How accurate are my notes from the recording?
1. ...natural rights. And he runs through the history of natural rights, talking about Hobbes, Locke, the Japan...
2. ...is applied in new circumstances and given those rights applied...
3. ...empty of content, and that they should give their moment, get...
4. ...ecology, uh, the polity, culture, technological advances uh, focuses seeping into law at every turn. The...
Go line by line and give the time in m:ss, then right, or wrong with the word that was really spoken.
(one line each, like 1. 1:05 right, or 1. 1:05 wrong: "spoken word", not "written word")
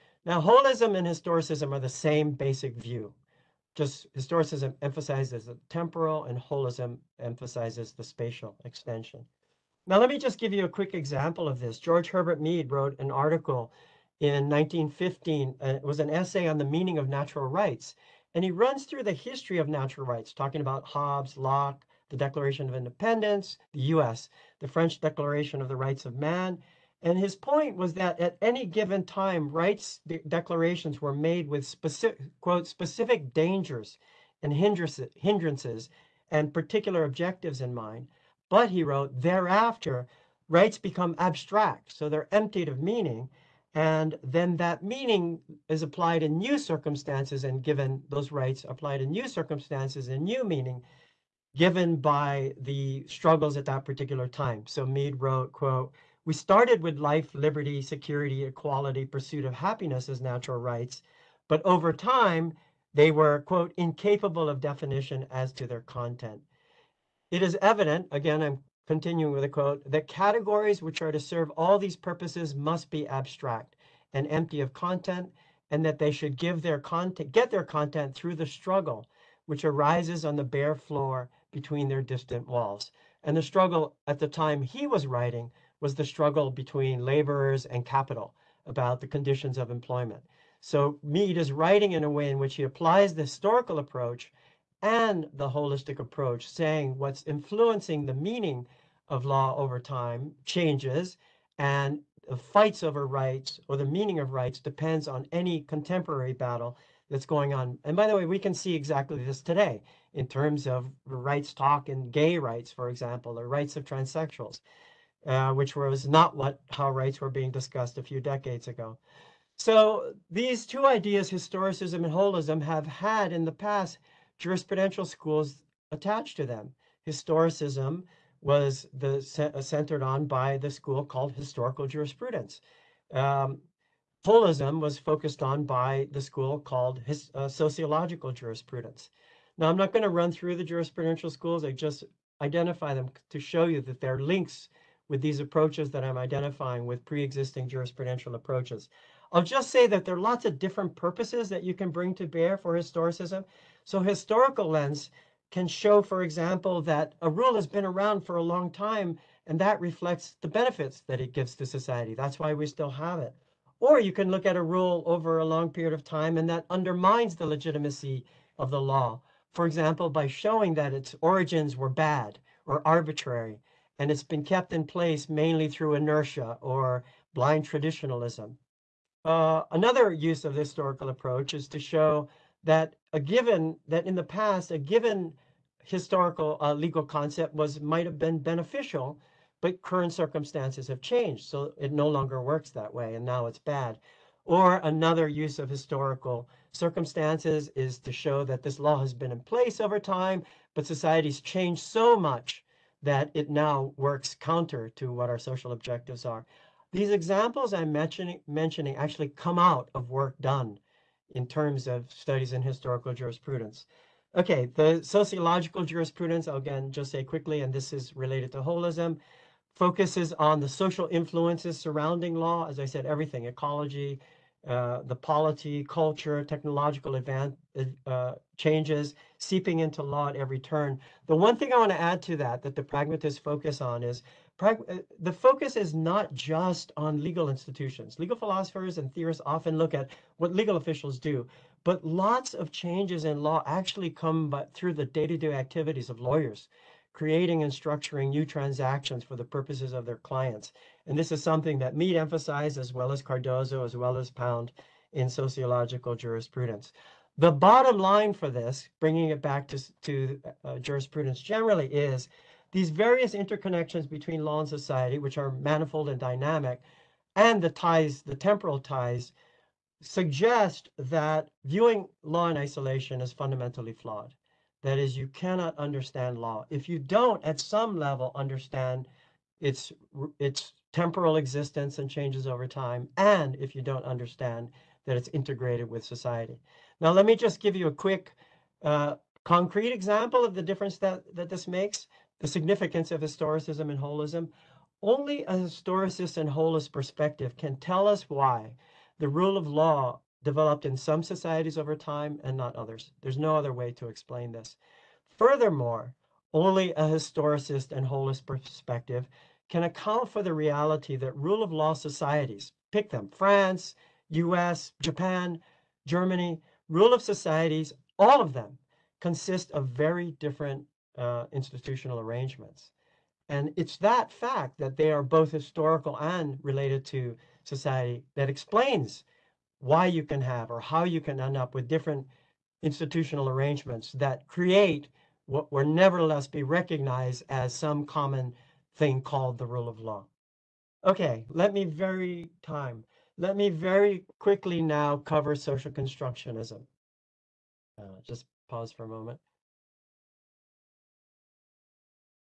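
1. 0:17 wrong: "Declaration", not "Japan"
2. 0:45 right
3. 1:14 wrong: "content", not "moment"
4. 3:43 wrong: "changes", not "focuses".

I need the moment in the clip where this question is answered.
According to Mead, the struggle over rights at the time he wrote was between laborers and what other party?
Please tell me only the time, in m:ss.
1:27.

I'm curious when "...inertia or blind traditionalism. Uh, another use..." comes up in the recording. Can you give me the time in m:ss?
2:55.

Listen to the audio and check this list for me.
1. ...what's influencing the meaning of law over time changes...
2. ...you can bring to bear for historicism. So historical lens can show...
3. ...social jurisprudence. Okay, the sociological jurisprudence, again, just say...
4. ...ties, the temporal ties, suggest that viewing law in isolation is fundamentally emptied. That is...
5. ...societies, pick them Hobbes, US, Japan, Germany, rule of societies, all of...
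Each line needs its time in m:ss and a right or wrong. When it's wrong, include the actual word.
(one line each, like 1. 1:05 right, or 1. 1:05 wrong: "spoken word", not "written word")
1. 1:36 right
2. 2:31 right
3. 3:32 wrong: "historical", not "social"
4. 4:27 wrong: "flawed", not "emptied"
5. 5:11 wrong: "France", not "Hobbes".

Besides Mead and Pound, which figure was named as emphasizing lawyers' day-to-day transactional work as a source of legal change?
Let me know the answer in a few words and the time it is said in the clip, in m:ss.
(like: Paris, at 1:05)
Cardozo, at 4:13.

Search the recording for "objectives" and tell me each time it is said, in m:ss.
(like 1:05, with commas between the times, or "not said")
0:37, 3:25.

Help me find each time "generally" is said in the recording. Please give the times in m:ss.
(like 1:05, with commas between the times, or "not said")
4:21.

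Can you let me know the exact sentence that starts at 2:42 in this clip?
That's why we still have it.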